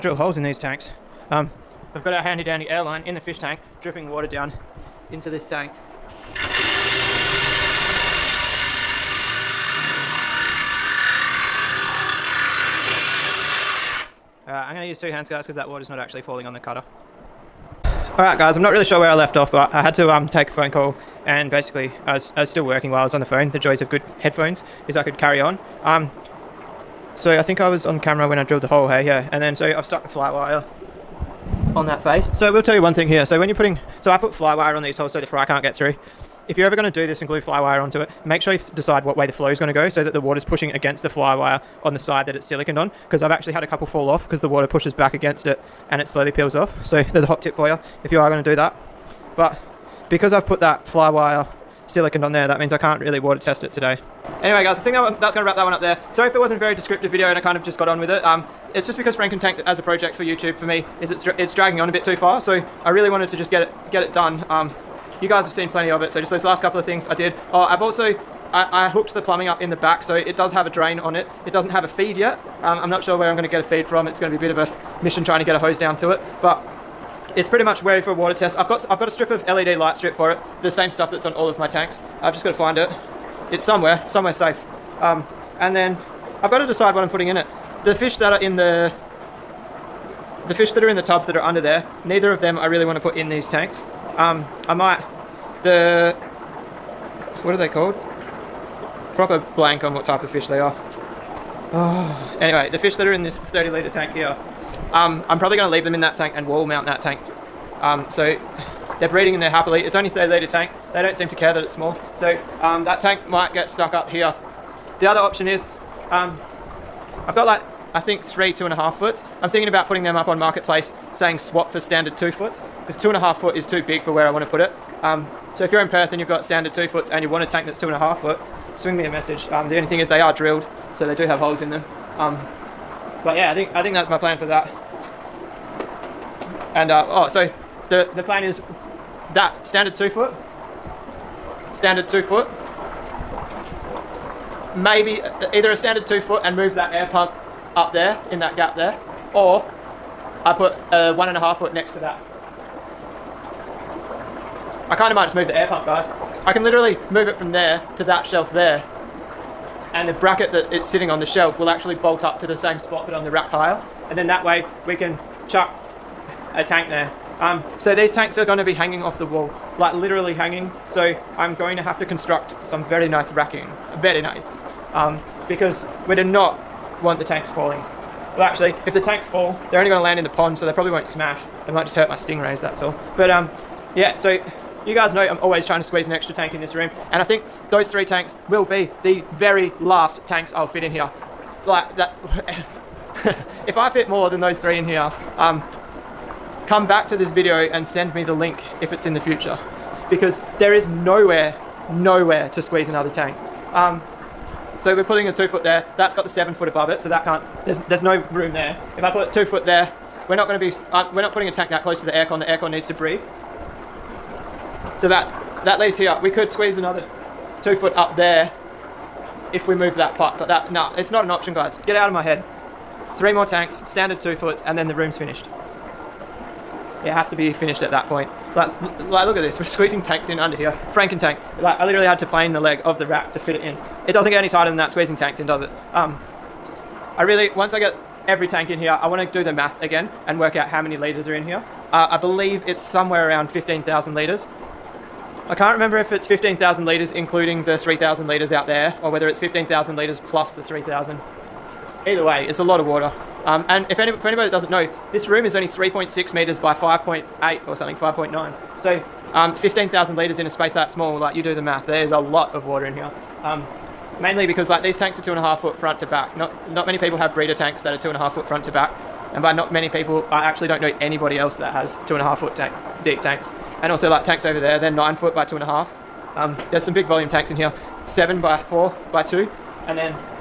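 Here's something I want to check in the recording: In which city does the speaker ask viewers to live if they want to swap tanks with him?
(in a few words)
Perth.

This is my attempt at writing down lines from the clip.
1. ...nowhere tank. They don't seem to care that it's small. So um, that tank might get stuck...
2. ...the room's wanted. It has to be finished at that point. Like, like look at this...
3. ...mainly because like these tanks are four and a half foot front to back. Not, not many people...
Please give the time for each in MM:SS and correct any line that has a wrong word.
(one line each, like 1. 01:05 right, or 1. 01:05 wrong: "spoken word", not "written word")
1. 01:50 wrong: "litre", not "nowhere"
2. 03:44 wrong: "finished", not "wanted"
3. 04:24 wrong: "two", not "four".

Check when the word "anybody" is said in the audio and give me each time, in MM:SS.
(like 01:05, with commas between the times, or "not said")
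04:14, 04:30.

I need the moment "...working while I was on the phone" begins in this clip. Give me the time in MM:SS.
00:22.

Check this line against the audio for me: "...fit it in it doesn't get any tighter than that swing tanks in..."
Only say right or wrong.
wrong.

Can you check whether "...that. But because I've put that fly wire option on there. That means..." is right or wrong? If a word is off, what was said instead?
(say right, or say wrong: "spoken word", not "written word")
wrong: "silicon", not "option".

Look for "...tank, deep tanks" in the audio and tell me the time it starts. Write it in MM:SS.
04:32.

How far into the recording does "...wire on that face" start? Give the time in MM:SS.
00:30.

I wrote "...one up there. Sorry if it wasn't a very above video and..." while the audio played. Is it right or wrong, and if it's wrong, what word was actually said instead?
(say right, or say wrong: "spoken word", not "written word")
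wrong: "descriptive", not "above".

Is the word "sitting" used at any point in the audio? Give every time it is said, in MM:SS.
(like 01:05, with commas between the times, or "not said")
02:40.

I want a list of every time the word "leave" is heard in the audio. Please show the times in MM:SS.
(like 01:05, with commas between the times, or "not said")
01:45, 03:35.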